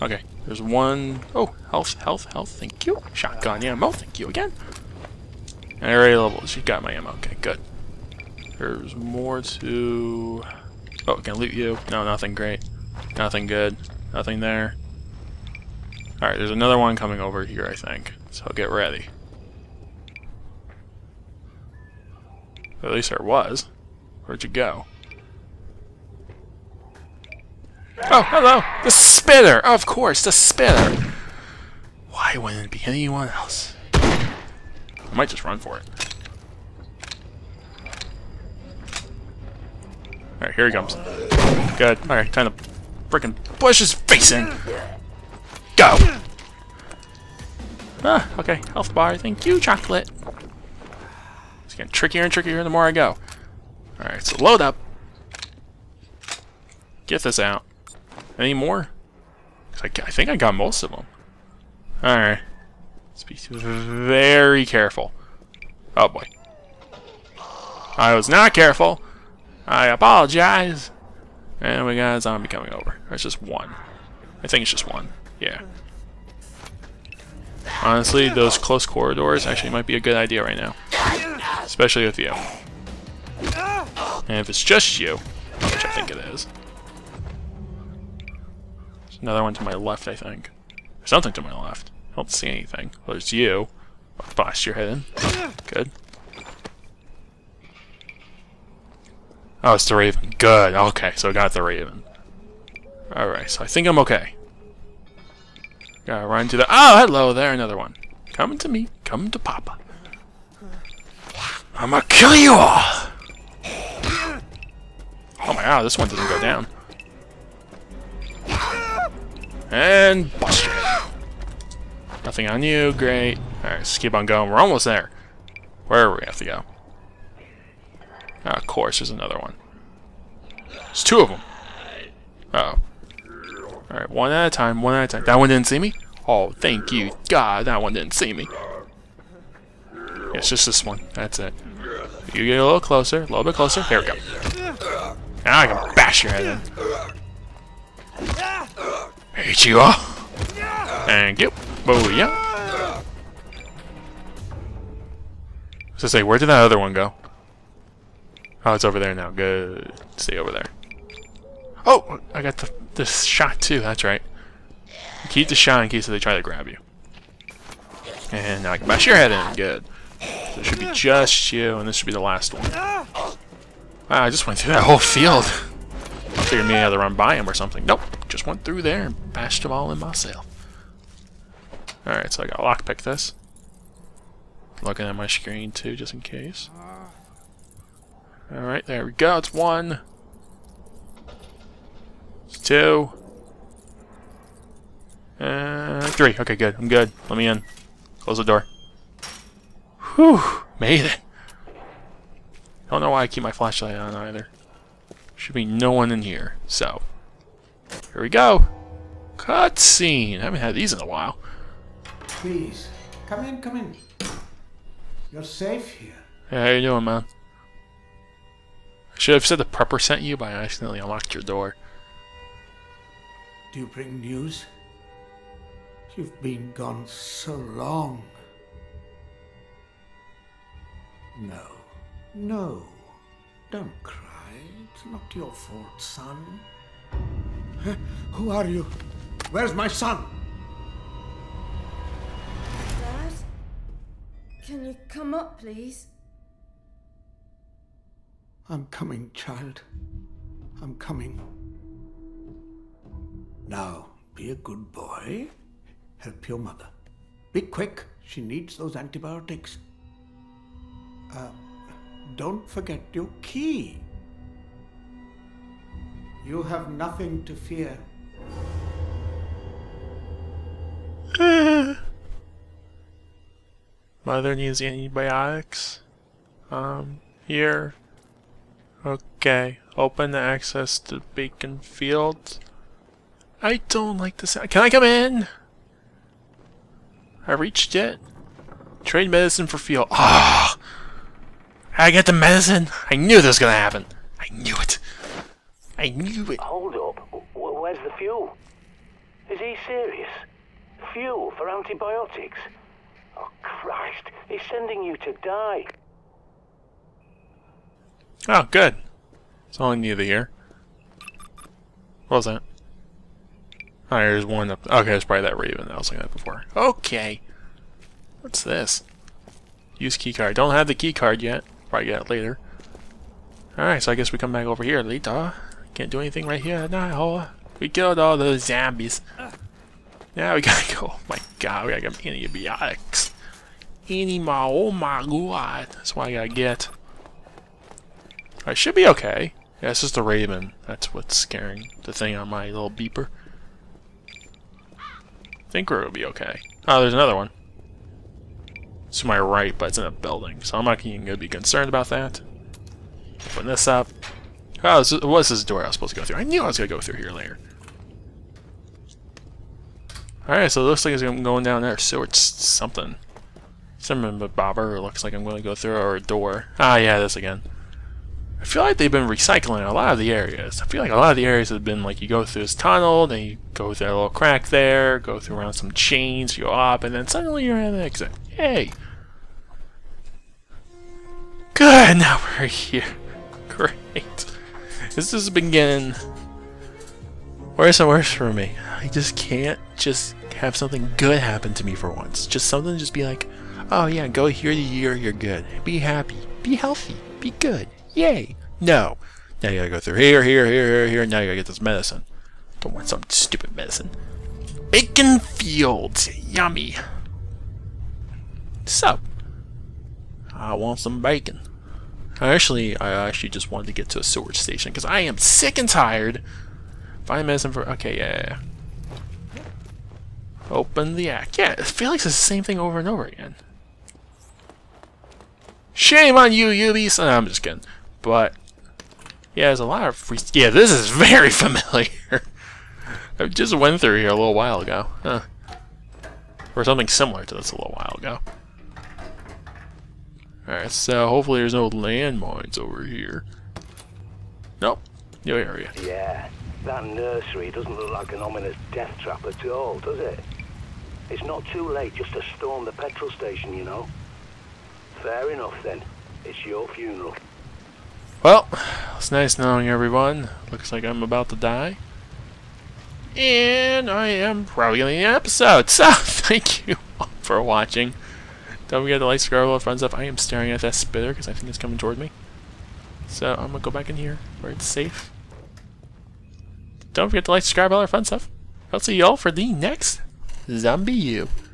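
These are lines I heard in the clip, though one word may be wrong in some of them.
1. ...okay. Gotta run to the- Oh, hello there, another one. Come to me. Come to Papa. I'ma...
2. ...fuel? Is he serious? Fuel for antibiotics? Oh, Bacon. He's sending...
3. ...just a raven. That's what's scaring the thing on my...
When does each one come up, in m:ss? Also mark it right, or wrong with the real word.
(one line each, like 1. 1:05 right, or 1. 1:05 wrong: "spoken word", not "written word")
1. 1:43 right
2. 4:58 wrong: "Christ", not "Bacon"
3. 5:40 right.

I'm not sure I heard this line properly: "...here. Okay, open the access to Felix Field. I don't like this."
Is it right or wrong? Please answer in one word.
wrong.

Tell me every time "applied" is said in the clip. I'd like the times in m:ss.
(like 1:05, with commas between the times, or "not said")
not said.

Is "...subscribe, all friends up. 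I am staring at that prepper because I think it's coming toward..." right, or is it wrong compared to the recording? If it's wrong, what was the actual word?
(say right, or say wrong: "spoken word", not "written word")
wrong: "spitter", not "prepper".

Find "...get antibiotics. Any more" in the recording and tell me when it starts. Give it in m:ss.
5:32.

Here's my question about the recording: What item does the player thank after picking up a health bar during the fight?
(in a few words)
Chocolate.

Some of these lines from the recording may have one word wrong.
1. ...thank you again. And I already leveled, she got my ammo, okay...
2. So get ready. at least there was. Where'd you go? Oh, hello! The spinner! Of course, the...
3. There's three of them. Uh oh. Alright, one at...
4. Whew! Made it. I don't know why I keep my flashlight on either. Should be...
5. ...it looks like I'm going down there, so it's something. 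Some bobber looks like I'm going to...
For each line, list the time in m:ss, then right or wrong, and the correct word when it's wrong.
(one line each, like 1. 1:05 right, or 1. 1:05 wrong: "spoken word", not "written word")
1. 0:03 right
2. 0:18 right
3. 2:10 wrong: "two", not "three"
4. 3:20 right
5. 6:00 right.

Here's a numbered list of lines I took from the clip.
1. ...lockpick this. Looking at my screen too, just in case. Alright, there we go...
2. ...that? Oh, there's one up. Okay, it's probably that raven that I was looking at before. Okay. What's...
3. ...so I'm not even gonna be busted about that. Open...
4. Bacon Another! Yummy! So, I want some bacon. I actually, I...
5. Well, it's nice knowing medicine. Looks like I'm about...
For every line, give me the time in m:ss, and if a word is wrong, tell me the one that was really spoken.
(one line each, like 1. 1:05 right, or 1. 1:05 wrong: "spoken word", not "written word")
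1. 3:02 right
2. 5:12 right
3. 5:50 wrong: "concerned", not "busted"
4. 6:44 wrong: "Fields", not "Another"
5. 7:38 wrong: "everyone", not "medicine".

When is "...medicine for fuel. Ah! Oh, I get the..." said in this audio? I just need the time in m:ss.
4:49.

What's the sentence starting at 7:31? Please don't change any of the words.
It's not too late just to storm the petrol station, you know.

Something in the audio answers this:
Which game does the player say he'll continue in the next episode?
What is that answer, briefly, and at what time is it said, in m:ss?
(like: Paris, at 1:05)
ZombiU, at 8:00.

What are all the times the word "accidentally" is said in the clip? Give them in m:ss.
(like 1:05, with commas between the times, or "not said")
3:40.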